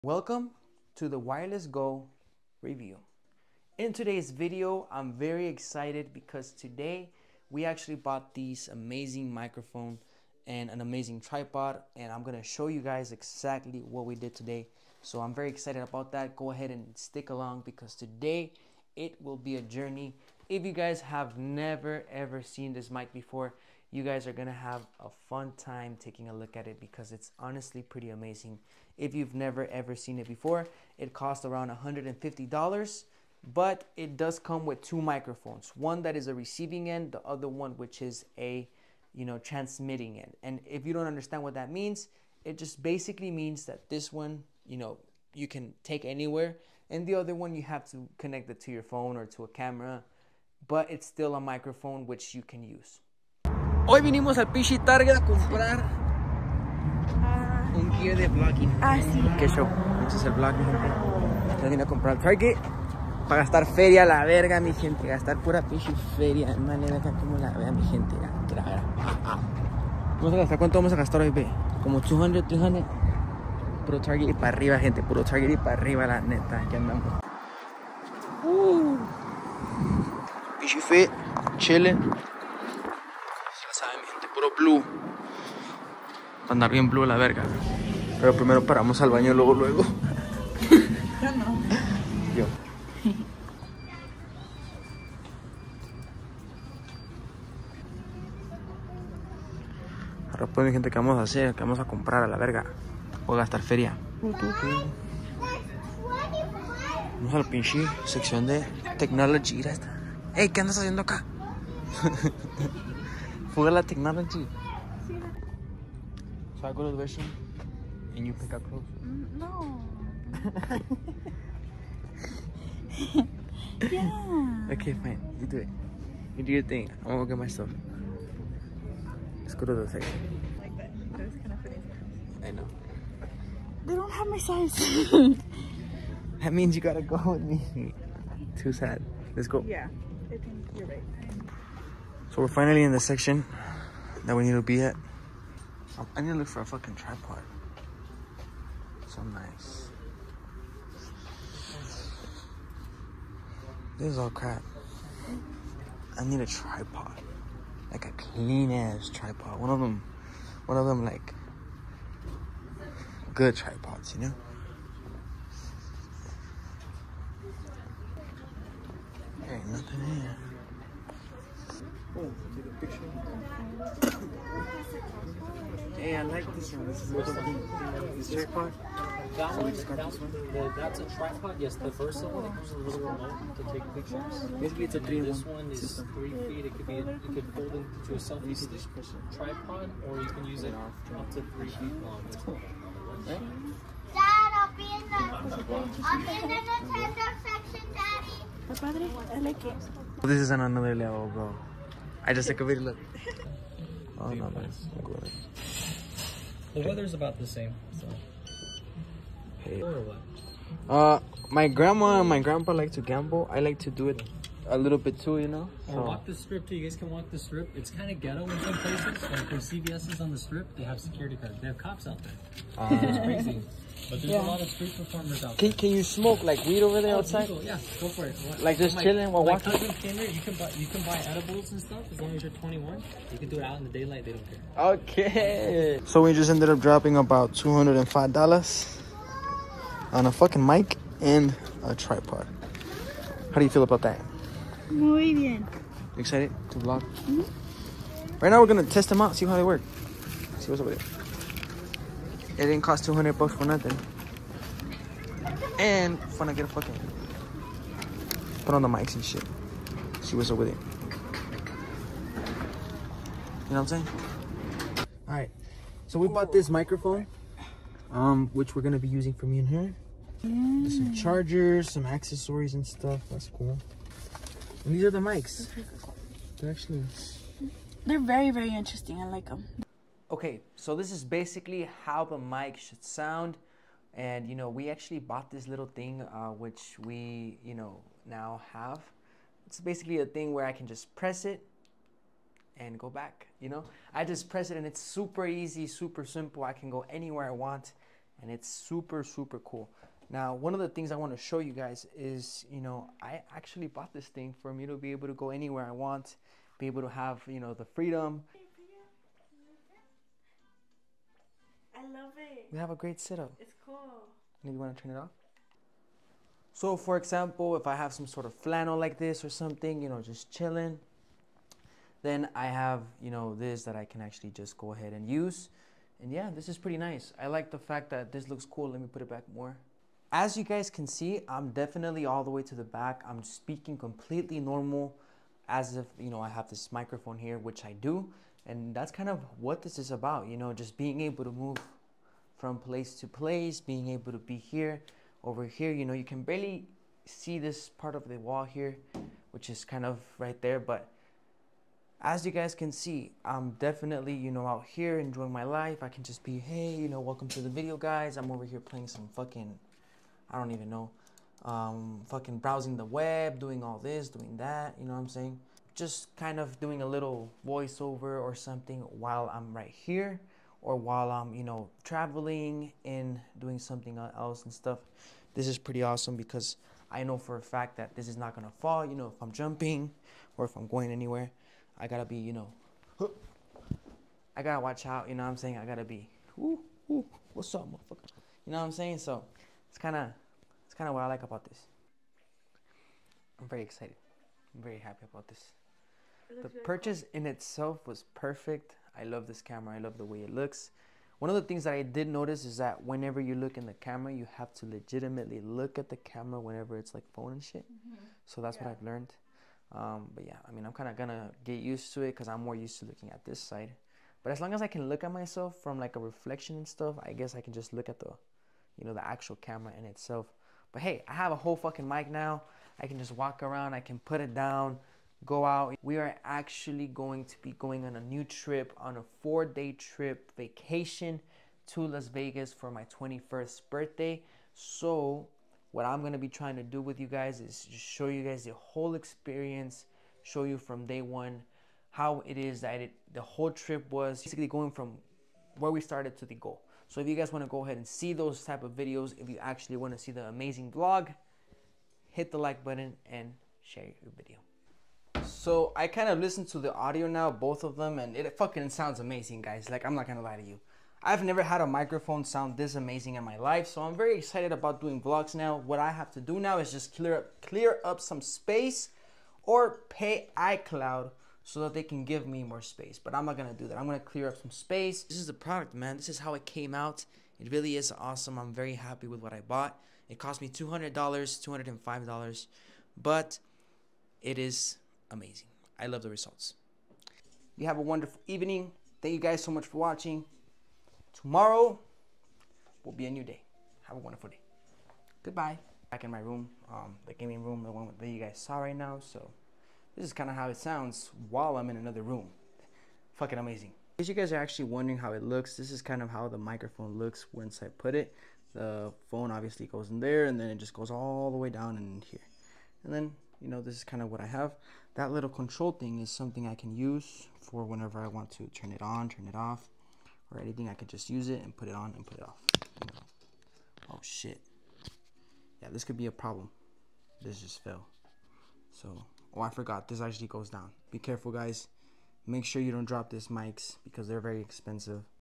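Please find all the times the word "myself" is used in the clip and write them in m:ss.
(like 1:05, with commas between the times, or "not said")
2:07, 6:55.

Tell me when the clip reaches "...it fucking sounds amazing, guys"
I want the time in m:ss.
7:38.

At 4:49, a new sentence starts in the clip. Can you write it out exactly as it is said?
It's basically a thing where I can just press it and go back, you know?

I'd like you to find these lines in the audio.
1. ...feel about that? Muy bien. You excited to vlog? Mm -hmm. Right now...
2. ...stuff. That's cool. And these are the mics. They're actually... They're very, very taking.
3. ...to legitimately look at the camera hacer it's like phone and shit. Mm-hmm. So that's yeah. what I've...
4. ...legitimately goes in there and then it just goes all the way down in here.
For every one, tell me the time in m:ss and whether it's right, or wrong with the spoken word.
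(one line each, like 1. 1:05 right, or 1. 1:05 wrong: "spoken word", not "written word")
1. 4:03 right
2. 4:32 wrong: "interesting", not "taking"
3. 6:44 wrong: "whenever", not "hacer"
4. 8:29 wrong: "obviously", not "legitimately".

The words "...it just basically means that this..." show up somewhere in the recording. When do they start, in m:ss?
0:42.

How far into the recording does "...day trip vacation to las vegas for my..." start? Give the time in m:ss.
7:09.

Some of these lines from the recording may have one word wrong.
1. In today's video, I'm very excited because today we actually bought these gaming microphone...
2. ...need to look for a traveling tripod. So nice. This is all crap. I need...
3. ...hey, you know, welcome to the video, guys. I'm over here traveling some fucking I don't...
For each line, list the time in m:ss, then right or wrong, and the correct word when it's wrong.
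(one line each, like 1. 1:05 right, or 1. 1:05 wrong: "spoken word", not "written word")
1. 0:03 wrong: "amazing", not "gaming"
2. 2:26 wrong: "fucking", not "traveling"
3. 5:56 wrong: "playing", not "traveling".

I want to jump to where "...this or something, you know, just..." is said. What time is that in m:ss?
5:19.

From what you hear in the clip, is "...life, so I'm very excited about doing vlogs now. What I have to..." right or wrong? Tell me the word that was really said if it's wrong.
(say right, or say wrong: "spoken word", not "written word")
right.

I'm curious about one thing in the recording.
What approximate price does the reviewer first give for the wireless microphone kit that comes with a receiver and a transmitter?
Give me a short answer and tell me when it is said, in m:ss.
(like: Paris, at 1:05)
$150, at 0:31.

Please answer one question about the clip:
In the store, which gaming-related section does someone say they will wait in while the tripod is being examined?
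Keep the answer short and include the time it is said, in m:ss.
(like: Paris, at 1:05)
Nintendo section, at 3:16.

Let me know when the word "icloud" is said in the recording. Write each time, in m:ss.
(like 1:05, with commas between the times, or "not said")
7:50.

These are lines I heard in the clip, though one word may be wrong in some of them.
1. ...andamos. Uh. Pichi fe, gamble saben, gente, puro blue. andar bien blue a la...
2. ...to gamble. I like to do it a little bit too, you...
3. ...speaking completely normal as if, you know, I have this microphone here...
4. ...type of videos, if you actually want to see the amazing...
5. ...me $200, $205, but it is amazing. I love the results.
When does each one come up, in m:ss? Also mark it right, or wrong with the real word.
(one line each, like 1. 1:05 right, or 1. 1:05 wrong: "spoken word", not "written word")
1. 1:16 wrong: "chile", not "gamble"
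2. 3:32 right
3. 5:33 right
4. 7:28 right
5. 8:00 right.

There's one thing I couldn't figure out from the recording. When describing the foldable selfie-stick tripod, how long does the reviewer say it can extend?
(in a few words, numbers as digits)
3 feet.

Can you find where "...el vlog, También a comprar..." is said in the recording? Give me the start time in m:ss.
1:00.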